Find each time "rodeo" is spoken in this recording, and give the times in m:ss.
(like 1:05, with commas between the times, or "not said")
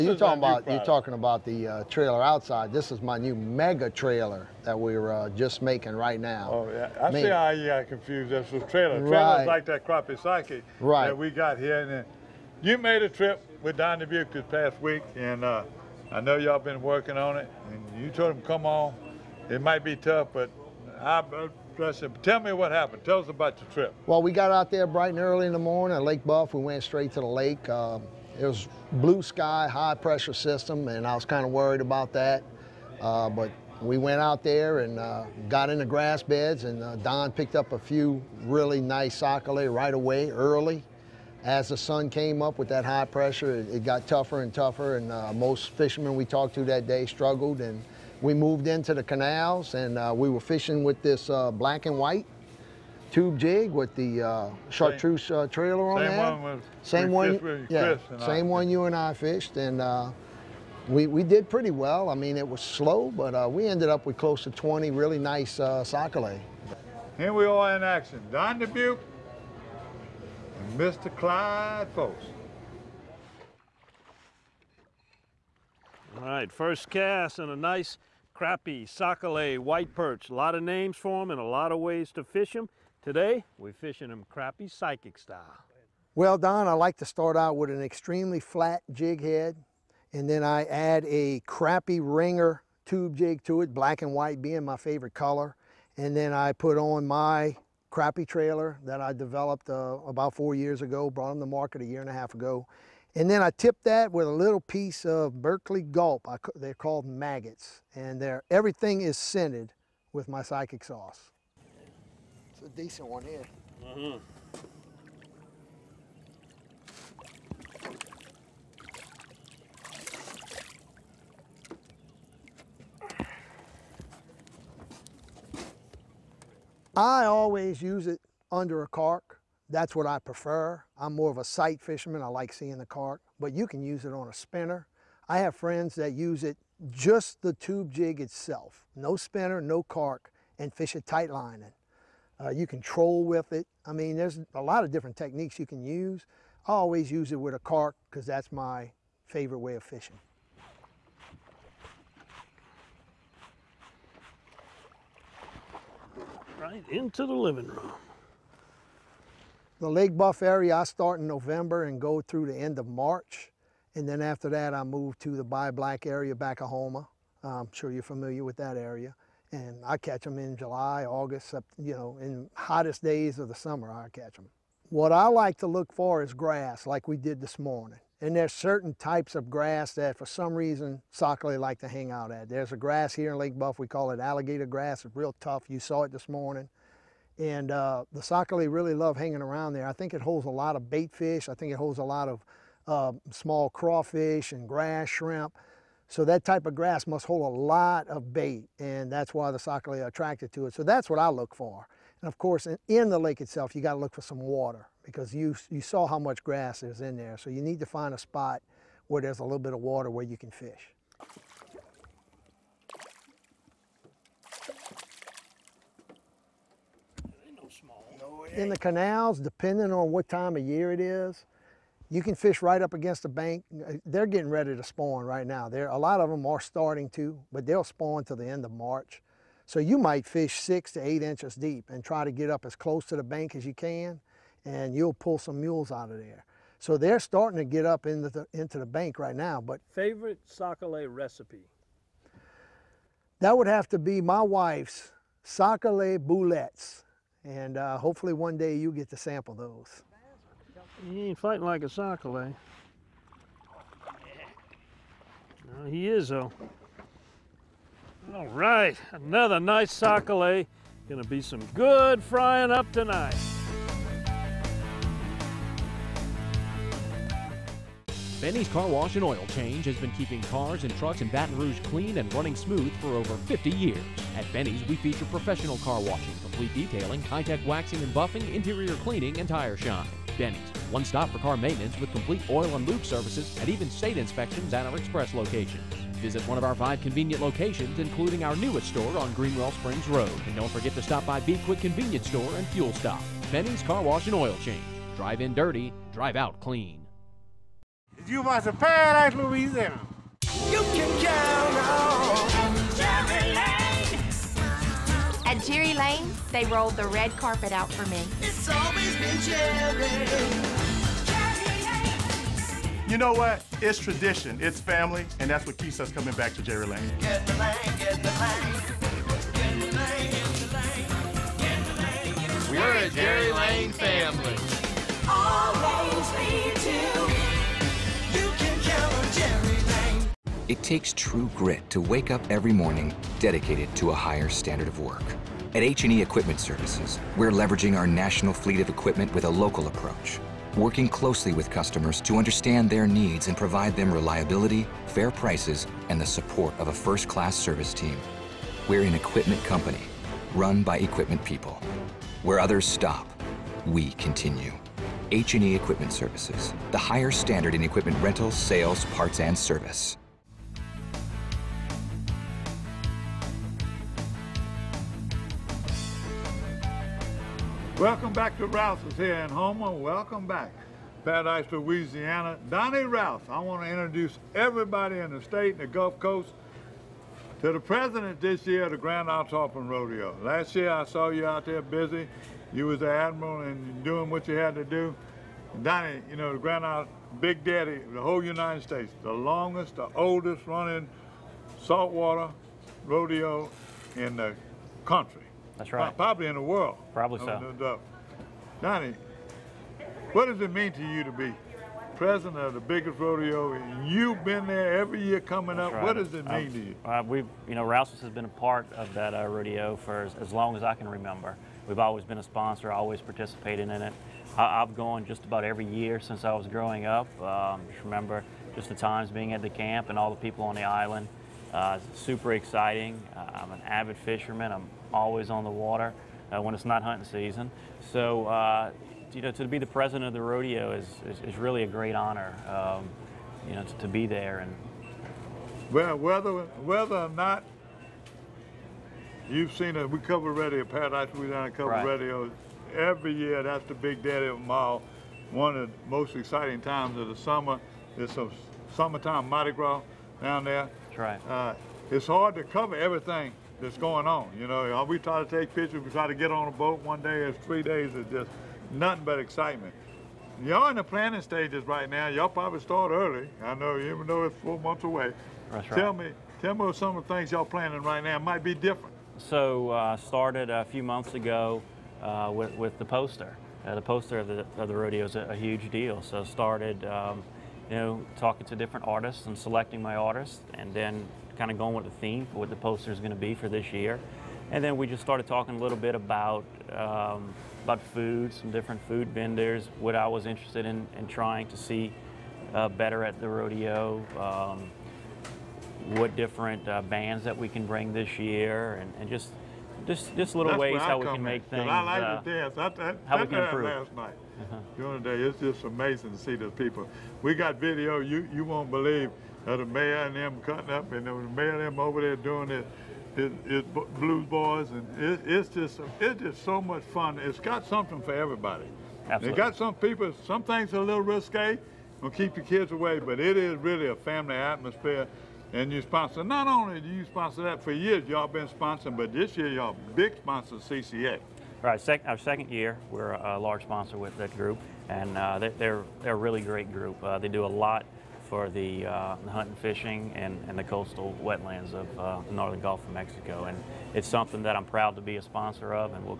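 6:19, 6:33, 6:43, 6:49, 7:10, 7:54, 8:13.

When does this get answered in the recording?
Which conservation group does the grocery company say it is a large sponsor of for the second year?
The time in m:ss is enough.
8:50.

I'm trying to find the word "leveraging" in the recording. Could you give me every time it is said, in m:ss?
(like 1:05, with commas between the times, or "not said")
5:37.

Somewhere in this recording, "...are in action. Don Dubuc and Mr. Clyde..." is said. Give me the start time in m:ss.
1:07.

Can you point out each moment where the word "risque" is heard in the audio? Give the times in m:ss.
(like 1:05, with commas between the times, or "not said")
8:41.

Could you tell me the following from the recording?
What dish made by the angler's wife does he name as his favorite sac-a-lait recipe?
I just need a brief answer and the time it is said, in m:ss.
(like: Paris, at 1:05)
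sac-a-lait boulettes, at 4:05.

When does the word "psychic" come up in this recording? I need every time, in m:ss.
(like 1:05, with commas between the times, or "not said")
0:10, 1:24, 1:50.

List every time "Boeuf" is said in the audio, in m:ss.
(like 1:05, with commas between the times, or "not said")
0:26, 2:40, 3:03.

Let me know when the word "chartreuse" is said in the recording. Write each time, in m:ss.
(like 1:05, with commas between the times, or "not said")
0:54.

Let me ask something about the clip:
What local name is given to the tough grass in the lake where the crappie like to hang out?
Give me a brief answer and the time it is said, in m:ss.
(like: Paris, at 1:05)
alligator grass, at 3:04.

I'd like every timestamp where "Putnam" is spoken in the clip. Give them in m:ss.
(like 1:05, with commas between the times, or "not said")
not said.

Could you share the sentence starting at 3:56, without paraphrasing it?
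So they're starting to get up into the, into the bank right now.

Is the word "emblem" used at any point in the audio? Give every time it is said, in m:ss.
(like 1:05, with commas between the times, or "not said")
not said.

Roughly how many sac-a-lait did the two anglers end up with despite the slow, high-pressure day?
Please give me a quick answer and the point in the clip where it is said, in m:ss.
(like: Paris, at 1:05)
close to 20, at 1:04.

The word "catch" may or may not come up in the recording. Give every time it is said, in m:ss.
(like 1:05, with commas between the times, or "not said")
2:49, 2:54.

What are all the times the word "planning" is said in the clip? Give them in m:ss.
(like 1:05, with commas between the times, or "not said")
7:41, 7:47.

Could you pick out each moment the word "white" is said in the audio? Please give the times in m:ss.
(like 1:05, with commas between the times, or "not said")
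0:51, 1:19, 1:34.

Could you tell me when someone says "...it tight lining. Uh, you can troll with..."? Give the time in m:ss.
2:20.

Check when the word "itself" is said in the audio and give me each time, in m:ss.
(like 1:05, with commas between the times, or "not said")
2:18, 3:23.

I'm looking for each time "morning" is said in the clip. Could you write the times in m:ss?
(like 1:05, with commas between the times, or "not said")
0:25, 2:57, 3:06, 5:32.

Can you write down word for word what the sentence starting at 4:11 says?
He ain't fighting like a sac-a-lait.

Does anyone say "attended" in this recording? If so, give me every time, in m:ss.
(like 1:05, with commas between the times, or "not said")
not said.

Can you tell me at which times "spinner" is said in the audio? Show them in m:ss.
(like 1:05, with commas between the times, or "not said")
2:14, 2:19.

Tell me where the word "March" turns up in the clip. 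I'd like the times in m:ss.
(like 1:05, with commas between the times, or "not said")
2:42, 3:48.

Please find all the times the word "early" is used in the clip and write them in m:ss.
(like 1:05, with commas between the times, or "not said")
0:25, 0:40, 7:43.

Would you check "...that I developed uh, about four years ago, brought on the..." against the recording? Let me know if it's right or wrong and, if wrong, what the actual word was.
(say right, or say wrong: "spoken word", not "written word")
right.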